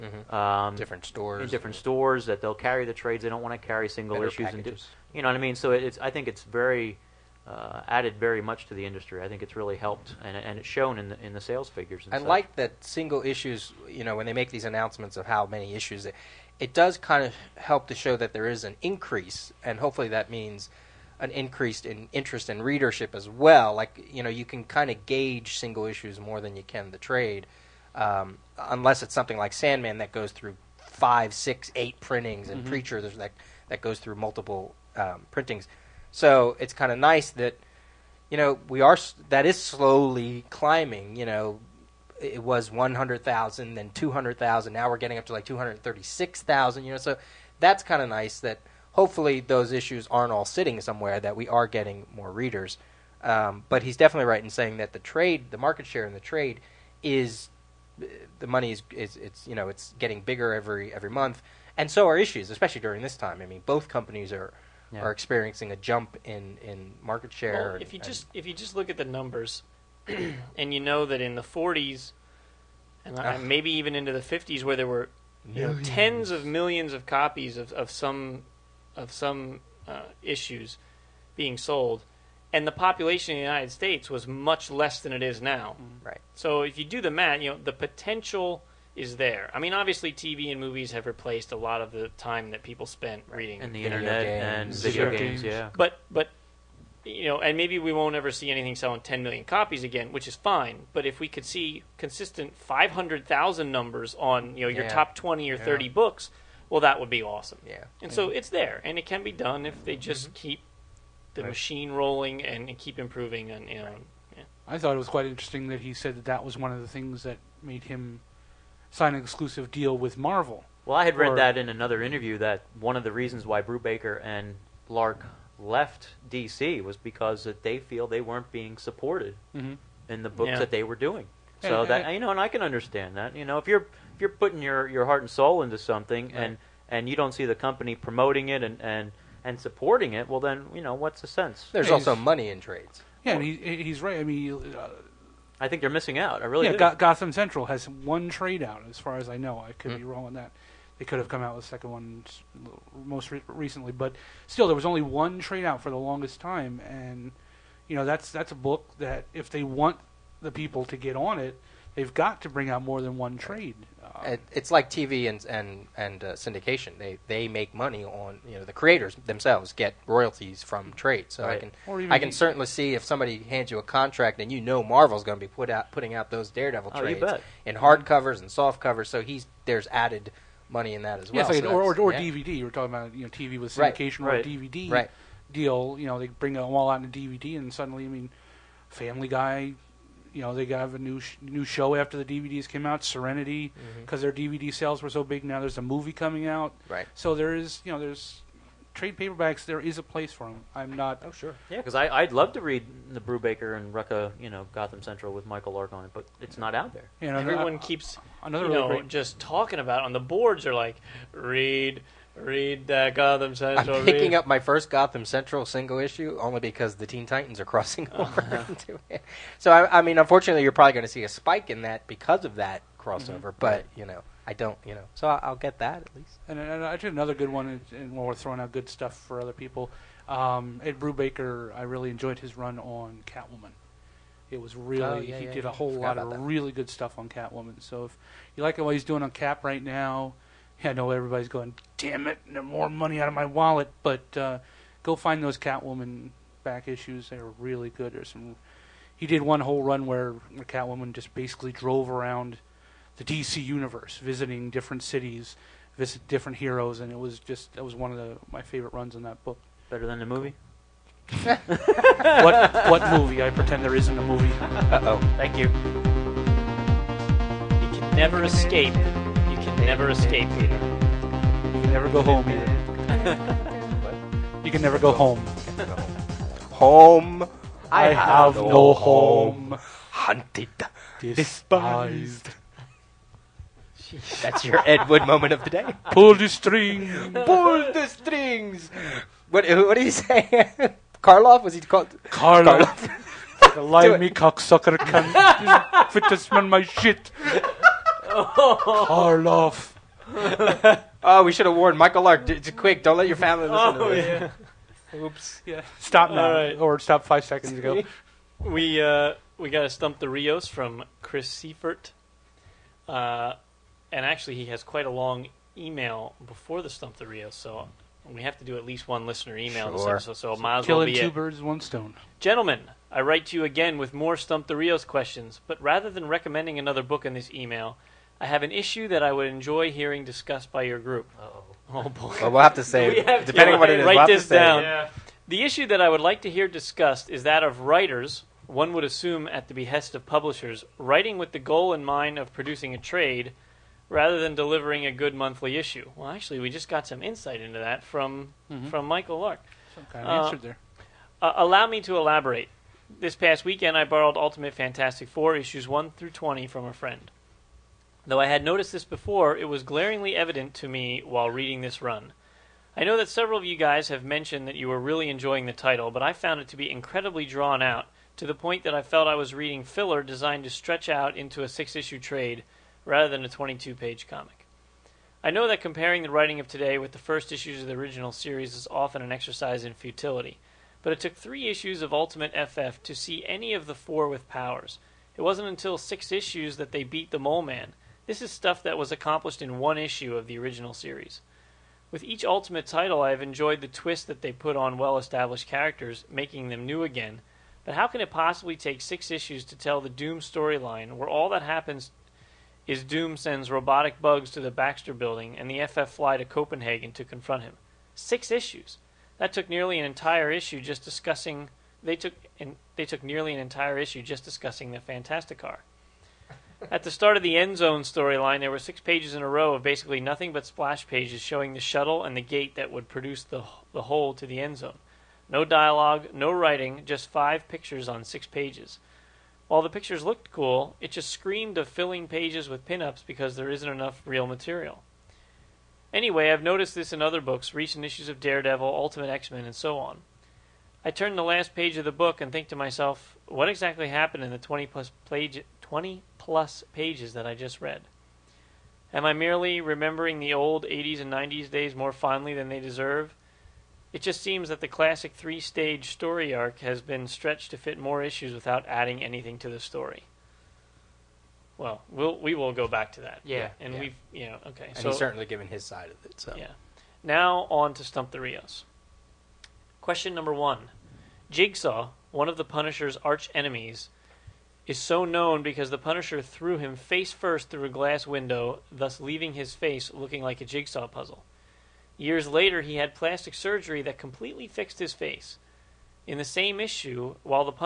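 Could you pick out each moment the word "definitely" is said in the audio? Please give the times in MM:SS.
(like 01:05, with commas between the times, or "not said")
00:53.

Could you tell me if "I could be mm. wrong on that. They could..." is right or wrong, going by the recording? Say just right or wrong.
right.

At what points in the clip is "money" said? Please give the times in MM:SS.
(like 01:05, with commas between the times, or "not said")
00:58, 02:22, 02:47, 03:00, 04:02.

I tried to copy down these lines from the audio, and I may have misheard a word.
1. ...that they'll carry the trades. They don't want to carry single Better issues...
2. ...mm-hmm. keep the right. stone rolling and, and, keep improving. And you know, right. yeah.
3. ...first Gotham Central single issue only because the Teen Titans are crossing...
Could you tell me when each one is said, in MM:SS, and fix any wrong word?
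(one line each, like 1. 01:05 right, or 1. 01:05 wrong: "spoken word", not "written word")
1. 00:02 right
2. 01:50 wrong: "machine", not "stone"
3. 03:34 right.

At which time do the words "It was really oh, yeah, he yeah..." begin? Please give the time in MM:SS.
03:54.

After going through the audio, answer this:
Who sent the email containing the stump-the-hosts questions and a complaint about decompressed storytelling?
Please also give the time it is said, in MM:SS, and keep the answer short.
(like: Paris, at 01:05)
Chris Seifert, at 05:11.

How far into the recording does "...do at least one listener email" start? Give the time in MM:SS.
05:18.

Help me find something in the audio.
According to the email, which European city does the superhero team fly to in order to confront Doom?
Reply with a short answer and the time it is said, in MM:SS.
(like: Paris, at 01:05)
Copenhagen, at 06:46.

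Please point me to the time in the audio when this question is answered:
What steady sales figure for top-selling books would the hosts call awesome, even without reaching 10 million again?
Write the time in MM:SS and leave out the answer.
01:42.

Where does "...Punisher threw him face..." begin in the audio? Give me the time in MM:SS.
07:55.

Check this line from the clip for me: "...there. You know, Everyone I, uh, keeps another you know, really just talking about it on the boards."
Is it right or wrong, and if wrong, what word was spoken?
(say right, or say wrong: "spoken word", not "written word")
right.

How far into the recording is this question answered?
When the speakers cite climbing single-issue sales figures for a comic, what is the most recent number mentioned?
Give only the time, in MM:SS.
00:45.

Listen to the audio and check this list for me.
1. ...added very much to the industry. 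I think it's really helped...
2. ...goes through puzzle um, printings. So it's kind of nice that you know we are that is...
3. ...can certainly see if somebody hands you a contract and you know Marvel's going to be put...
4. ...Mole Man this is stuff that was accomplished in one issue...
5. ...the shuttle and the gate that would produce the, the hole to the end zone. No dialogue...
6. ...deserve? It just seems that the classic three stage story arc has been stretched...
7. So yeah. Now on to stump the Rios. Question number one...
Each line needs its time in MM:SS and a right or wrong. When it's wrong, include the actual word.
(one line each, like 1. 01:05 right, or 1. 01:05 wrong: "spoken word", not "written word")
1. 00:07 right
2. 00:33 wrong: "multiple", not "puzzle"
3. 02:52 right
4. 06:27 right
5. 07:01 right
6. 07:32 right
7. 07:46 right.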